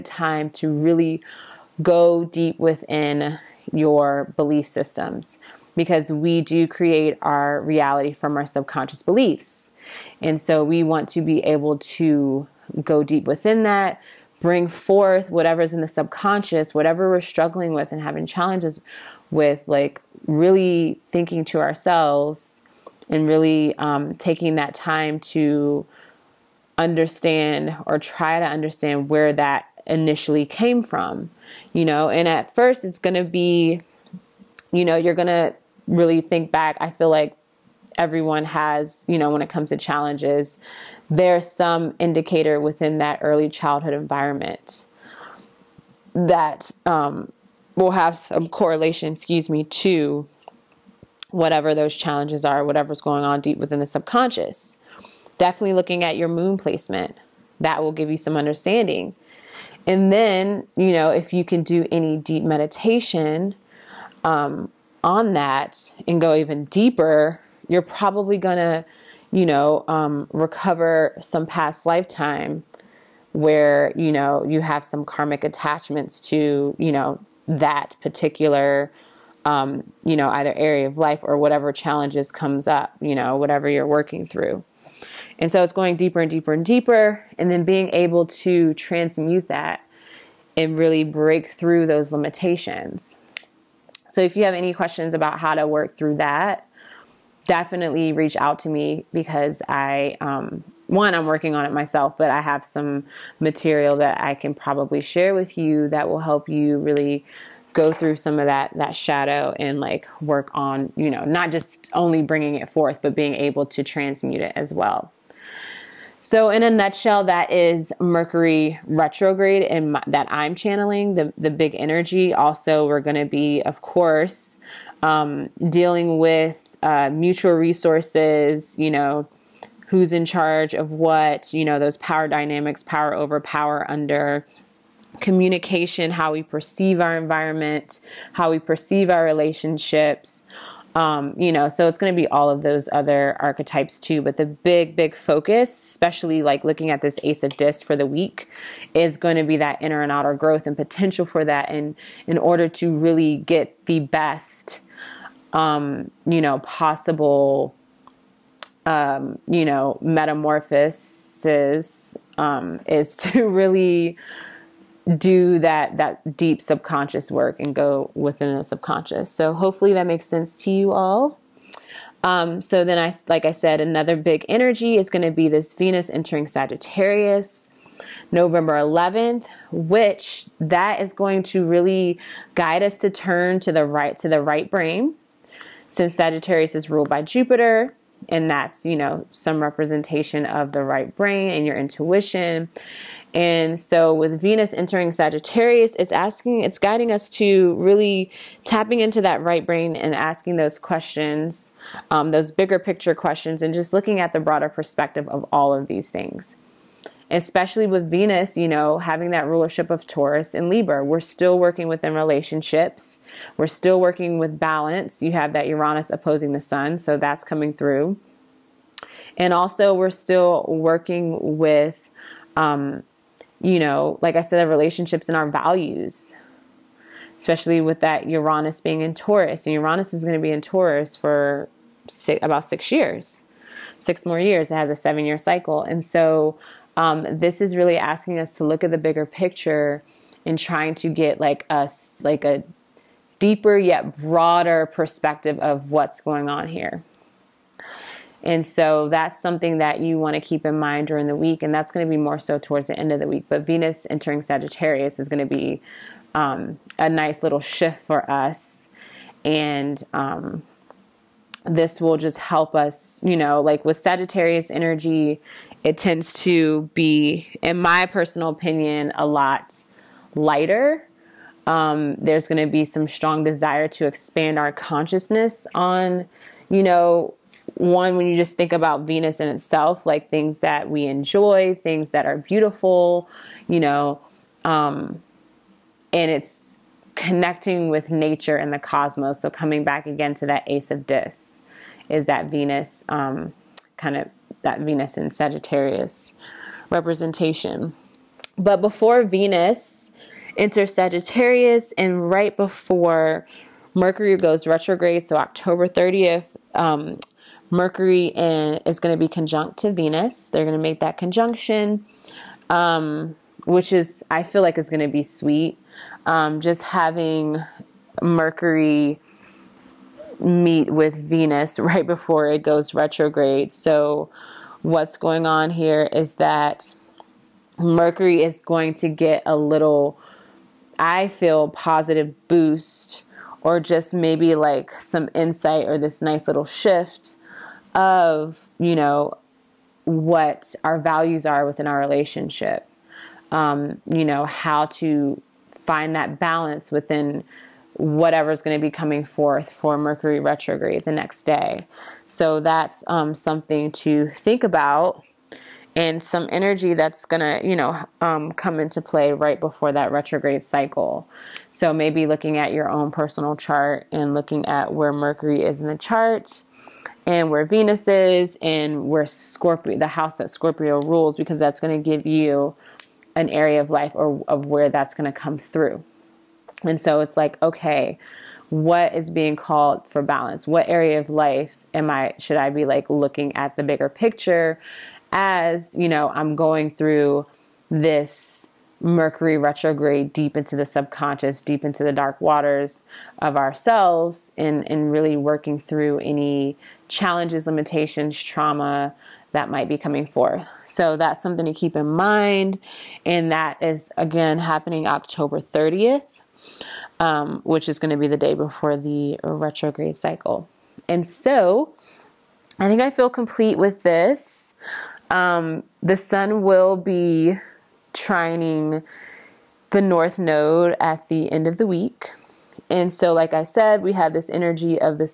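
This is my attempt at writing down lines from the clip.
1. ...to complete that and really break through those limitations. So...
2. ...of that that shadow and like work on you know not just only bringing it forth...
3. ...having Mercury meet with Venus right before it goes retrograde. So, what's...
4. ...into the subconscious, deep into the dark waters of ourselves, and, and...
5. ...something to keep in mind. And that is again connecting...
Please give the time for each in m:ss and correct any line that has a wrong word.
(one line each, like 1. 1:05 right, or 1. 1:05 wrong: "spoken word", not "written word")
1. 1:28 wrong: "transmute", not "complete"
2. 1:48 right
3. 5:16 right
4. 6:30 right
5. 6:41 wrong: "happening", not "connecting".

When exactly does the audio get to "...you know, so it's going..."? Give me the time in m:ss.
2:21.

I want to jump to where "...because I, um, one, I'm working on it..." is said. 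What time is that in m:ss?
1:39.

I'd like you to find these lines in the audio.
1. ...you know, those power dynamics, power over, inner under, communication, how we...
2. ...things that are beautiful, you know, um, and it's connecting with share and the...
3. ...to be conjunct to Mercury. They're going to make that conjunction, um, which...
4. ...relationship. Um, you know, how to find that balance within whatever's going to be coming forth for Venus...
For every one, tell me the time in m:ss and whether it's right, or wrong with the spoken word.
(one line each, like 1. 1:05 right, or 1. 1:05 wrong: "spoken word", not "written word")
1. 2:11 wrong: "power", not "inner"
2. 4:41 wrong: "nature", not "share"
3. 5:09 wrong: "Venus", not "Mercury"
4. 5:41 wrong: "Mercury", not "Venus".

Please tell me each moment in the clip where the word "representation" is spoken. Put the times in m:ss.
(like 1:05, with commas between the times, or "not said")
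3:09, 4:56.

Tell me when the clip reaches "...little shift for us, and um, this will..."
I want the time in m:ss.
4:17.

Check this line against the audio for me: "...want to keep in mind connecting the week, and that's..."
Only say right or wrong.
wrong.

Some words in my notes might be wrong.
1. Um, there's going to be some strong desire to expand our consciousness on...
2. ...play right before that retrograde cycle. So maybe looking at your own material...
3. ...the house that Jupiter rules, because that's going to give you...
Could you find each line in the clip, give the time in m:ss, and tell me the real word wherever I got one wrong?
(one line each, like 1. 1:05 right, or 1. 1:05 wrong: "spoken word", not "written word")
1. 4:31 right
2. 5:58 wrong: "personal", not "material"
3. 6:09 wrong: "Scorpio", not "Jupiter".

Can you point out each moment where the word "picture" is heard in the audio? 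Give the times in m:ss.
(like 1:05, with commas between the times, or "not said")
3:22, 3:59, 6:24.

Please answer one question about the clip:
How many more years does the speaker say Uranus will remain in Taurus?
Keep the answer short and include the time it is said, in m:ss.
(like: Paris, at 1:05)
6, at 3:53.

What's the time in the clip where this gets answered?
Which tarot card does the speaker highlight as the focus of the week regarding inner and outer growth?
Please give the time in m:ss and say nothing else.
2:27.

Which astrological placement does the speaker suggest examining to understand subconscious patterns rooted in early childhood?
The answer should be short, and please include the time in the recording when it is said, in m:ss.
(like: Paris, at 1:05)
Moon placement, at 0:56.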